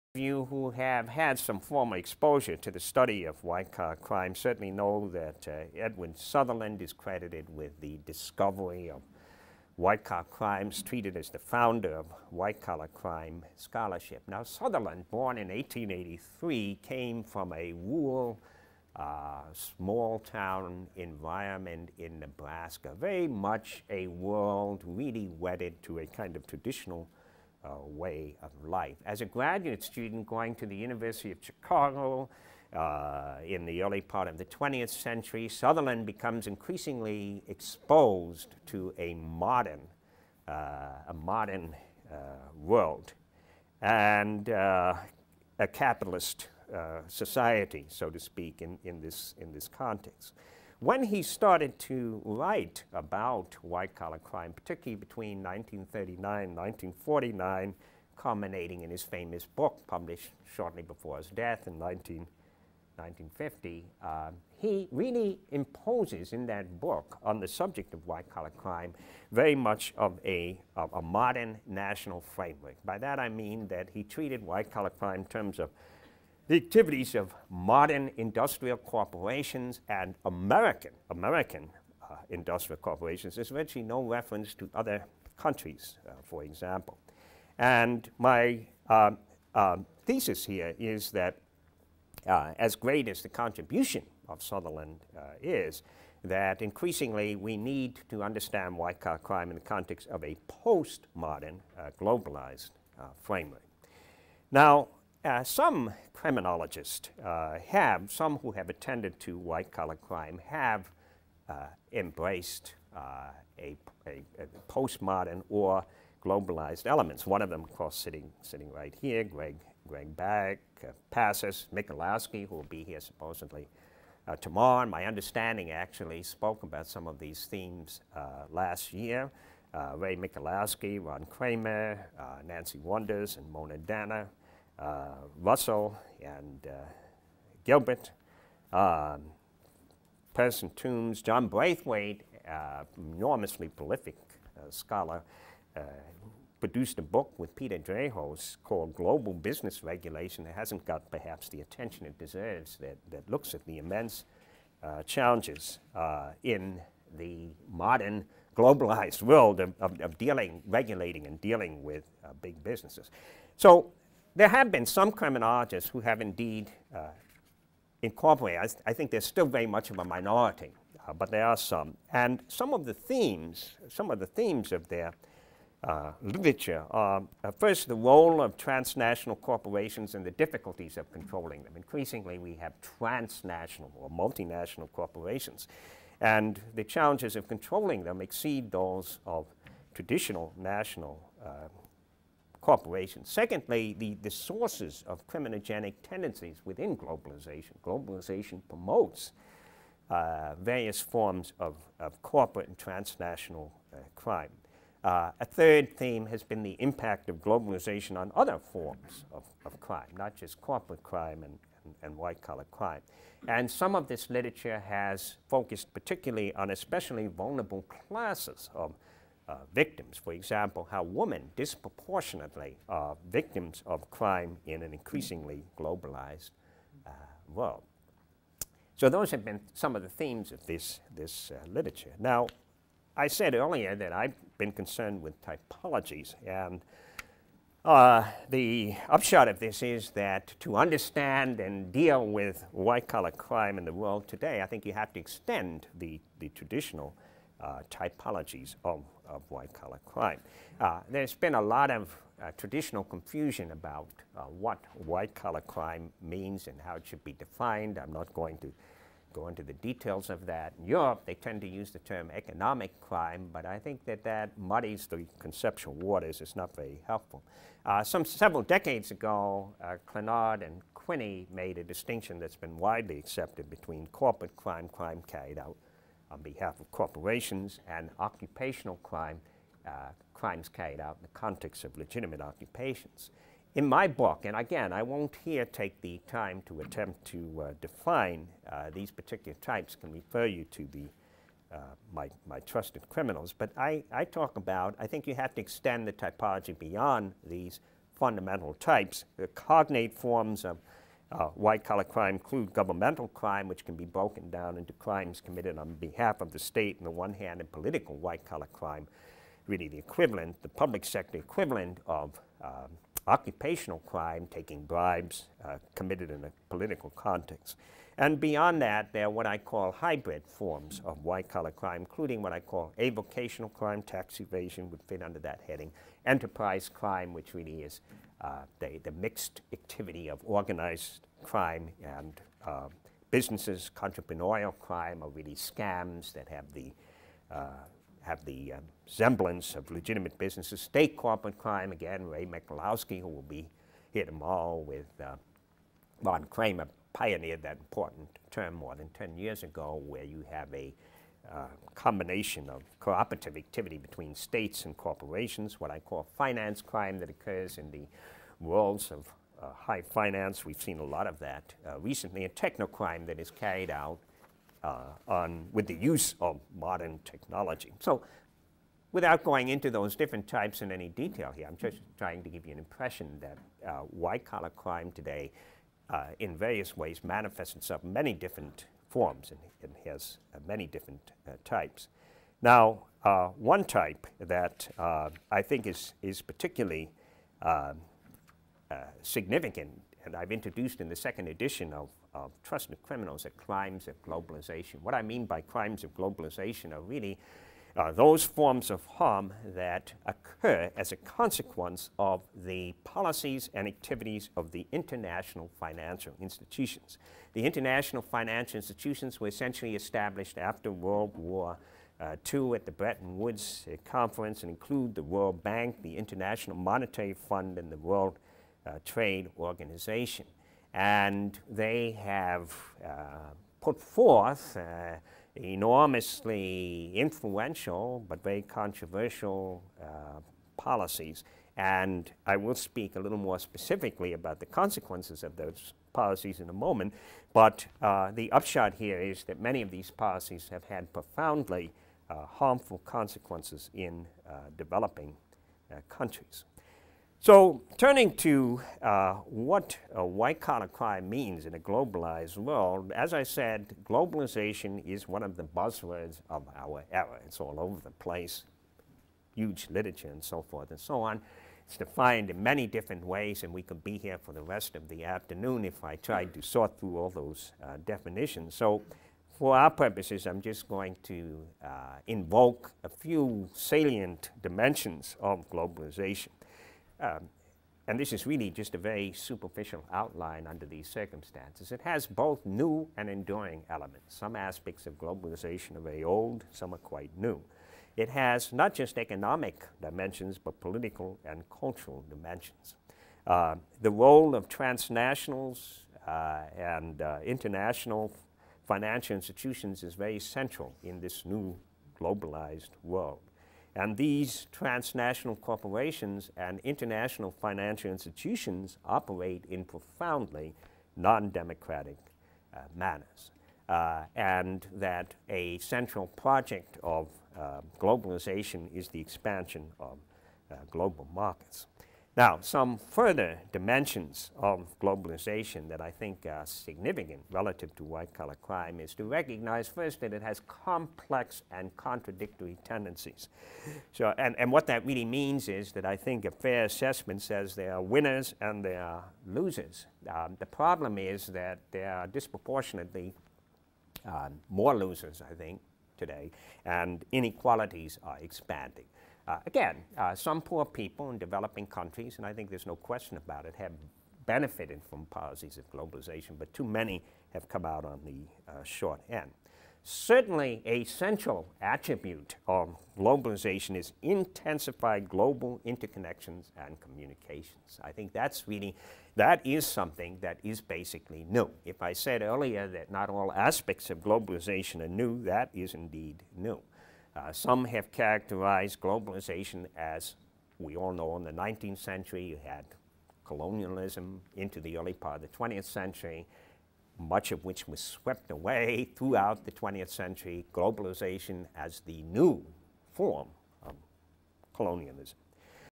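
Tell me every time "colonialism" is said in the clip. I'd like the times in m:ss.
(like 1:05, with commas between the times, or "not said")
9:43, 9:54.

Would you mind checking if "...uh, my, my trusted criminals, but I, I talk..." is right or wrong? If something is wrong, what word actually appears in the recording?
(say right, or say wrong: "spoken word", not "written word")
right.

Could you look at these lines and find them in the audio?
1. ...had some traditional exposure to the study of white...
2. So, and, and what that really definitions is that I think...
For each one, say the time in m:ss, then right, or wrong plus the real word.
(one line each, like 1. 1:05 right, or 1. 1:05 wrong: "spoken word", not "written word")
1. 0:01 wrong: "formal", not "traditional"
2. 8:54 wrong: "means", not "definitions".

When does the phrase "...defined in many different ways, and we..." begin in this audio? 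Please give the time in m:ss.
7:41.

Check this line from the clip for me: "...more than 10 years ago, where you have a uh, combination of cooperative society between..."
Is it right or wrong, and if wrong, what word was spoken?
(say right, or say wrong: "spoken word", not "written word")
wrong: "activity", not "society".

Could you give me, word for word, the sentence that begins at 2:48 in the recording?
I, th I, think there's still very much of a minority, uh, but there are some.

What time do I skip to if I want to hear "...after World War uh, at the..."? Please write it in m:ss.
6:50.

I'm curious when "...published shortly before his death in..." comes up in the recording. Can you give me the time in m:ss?
0:59.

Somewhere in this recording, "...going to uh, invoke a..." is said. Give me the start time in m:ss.
7:50.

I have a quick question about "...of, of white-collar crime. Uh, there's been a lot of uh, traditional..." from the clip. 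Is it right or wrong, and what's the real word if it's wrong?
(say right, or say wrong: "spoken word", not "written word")
right.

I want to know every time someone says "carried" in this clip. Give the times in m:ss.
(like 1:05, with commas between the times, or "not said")
4:35, 4:40, 6:03.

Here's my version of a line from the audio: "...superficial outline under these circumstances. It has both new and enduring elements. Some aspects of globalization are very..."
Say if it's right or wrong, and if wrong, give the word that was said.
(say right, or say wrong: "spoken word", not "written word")
right.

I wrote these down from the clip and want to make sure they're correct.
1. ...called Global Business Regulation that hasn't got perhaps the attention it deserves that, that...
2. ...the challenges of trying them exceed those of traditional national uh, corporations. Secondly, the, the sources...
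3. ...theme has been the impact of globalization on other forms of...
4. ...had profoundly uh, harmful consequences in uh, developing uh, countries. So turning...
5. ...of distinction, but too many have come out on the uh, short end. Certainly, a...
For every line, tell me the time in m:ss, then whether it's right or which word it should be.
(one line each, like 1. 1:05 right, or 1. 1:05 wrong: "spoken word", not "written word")
1. 2:28 right
2. 3:06 wrong: "controlling", not "trying"
3. 3:25 right
4. 7:20 right
5. 9:15 wrong: "globalization", not "distinction".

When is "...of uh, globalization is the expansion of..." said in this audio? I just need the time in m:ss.
8:37.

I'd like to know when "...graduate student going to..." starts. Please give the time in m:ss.
0:29.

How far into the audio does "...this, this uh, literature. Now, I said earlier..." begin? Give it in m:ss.
3:50.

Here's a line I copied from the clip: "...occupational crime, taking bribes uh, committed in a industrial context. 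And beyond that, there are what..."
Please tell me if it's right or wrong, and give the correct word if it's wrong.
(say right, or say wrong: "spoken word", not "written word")
wrong: "political", not "industrial".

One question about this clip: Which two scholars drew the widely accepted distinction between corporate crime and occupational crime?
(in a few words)
Clinard and Quinney.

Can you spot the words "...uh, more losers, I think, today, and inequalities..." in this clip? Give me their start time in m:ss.
9:04.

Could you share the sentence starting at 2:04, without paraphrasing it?
my understanding actually spoke about some of these themes last year.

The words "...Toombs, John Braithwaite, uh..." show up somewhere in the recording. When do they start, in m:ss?
2:20.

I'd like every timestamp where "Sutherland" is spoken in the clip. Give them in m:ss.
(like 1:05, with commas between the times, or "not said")
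0:06, 0:14, 0:35, 1:34.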